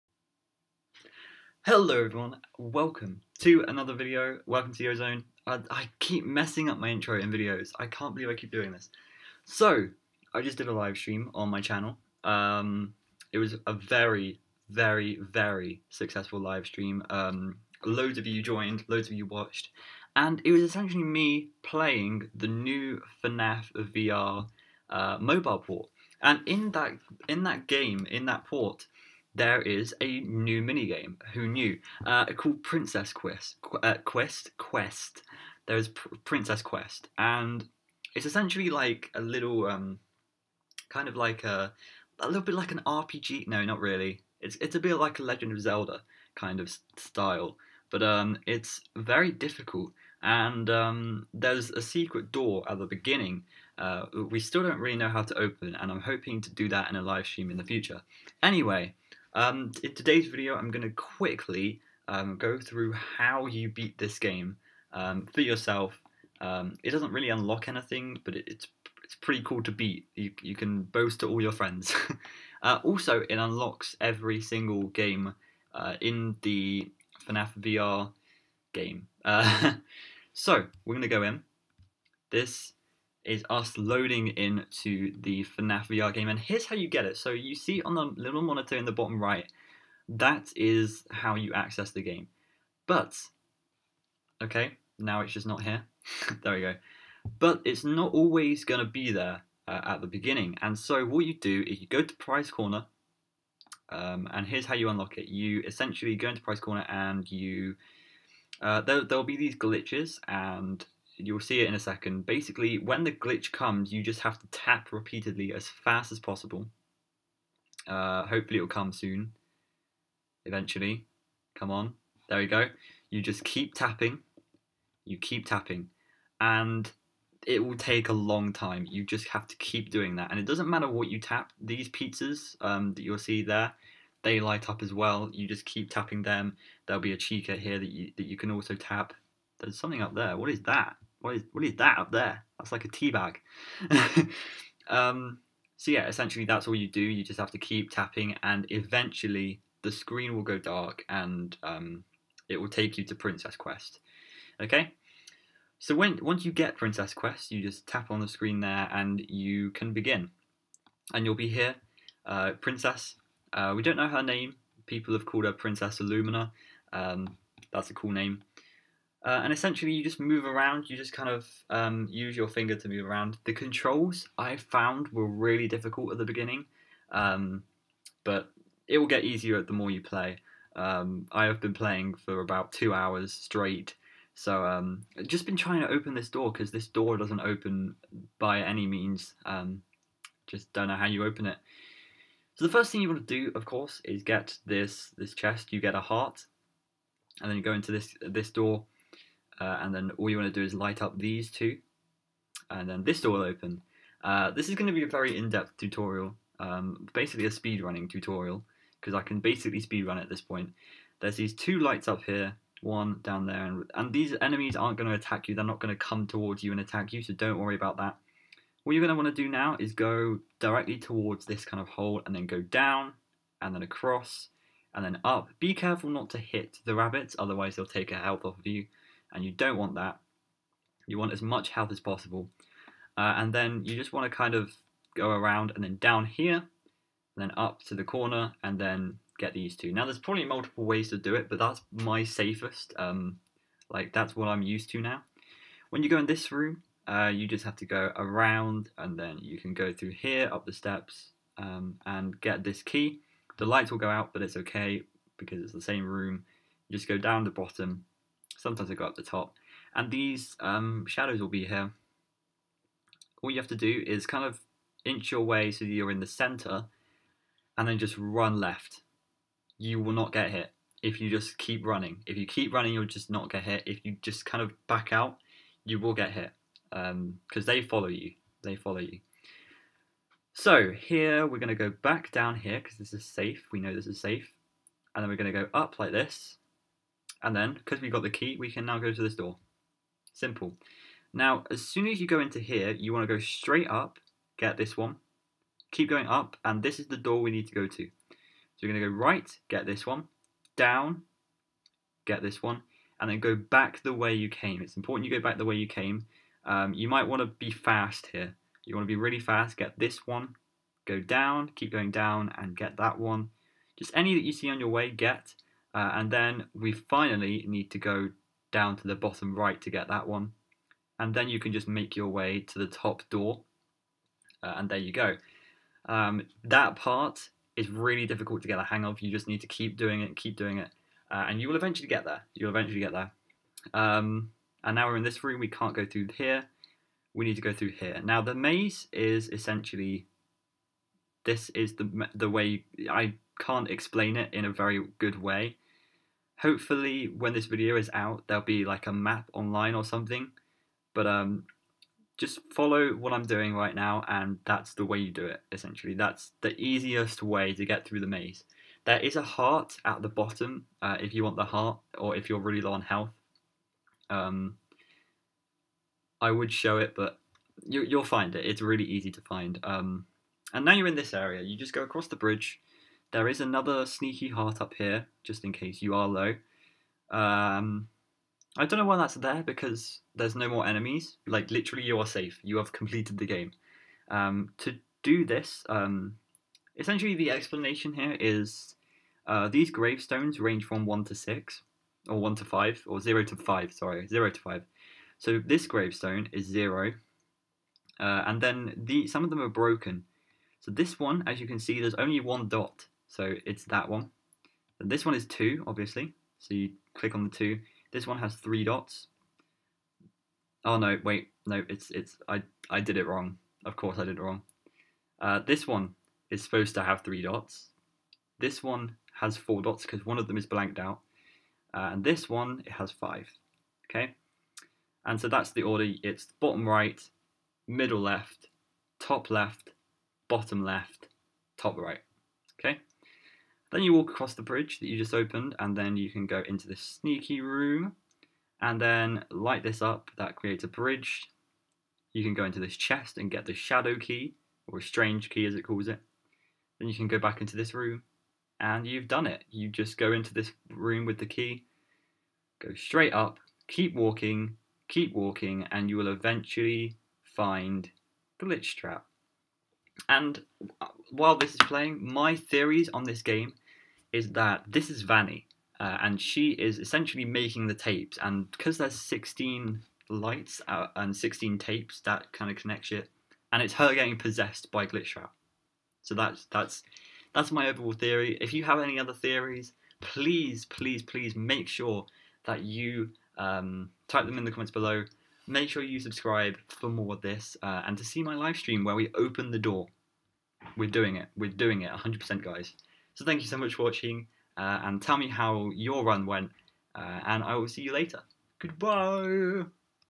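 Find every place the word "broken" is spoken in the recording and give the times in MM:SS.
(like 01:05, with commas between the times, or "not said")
06:39.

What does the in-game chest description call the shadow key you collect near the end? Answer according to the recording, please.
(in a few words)
strange key.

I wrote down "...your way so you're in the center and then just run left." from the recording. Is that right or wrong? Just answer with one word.
right.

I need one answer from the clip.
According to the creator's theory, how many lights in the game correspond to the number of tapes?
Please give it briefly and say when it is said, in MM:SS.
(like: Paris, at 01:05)
16, at 07:49.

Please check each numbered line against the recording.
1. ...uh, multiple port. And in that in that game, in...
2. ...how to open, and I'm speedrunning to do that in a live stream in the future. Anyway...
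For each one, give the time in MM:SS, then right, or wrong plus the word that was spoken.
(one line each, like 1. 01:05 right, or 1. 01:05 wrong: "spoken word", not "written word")
1. 00:24 wrong: "mobile", not "multiple"
2. 00:55 wrong: "hoping", not "speedrunning".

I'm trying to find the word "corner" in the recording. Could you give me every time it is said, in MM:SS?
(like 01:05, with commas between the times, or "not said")
01:42, 01:46, 03:58.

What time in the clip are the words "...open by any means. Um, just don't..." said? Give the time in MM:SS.
03:07.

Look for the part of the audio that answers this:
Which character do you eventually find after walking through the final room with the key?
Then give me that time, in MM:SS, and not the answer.
07:38.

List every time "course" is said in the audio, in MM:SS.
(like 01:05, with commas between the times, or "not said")
03:13, 06:53.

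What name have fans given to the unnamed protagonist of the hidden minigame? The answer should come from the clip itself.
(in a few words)
Princess Illumina.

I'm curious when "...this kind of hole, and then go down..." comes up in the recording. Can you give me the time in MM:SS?
03:41.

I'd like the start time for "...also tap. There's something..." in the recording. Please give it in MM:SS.
02:18.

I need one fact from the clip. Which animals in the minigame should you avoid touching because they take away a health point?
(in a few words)
rabbits.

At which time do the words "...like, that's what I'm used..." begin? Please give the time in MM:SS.
04:03.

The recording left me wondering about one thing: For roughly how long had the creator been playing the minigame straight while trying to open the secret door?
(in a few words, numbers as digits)
2 hours.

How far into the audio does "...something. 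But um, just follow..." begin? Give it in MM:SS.
05:50.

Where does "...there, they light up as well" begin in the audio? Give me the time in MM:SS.
02:13.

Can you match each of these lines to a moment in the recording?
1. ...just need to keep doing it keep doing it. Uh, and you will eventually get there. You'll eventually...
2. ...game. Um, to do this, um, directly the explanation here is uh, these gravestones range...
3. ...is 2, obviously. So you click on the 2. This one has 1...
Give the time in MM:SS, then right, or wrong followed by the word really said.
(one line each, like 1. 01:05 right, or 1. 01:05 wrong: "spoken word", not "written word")
1. 05:29 right
2. 06:23 wrong: "essentially", not "directly"
3. 06:45 wrong: "3", not "1".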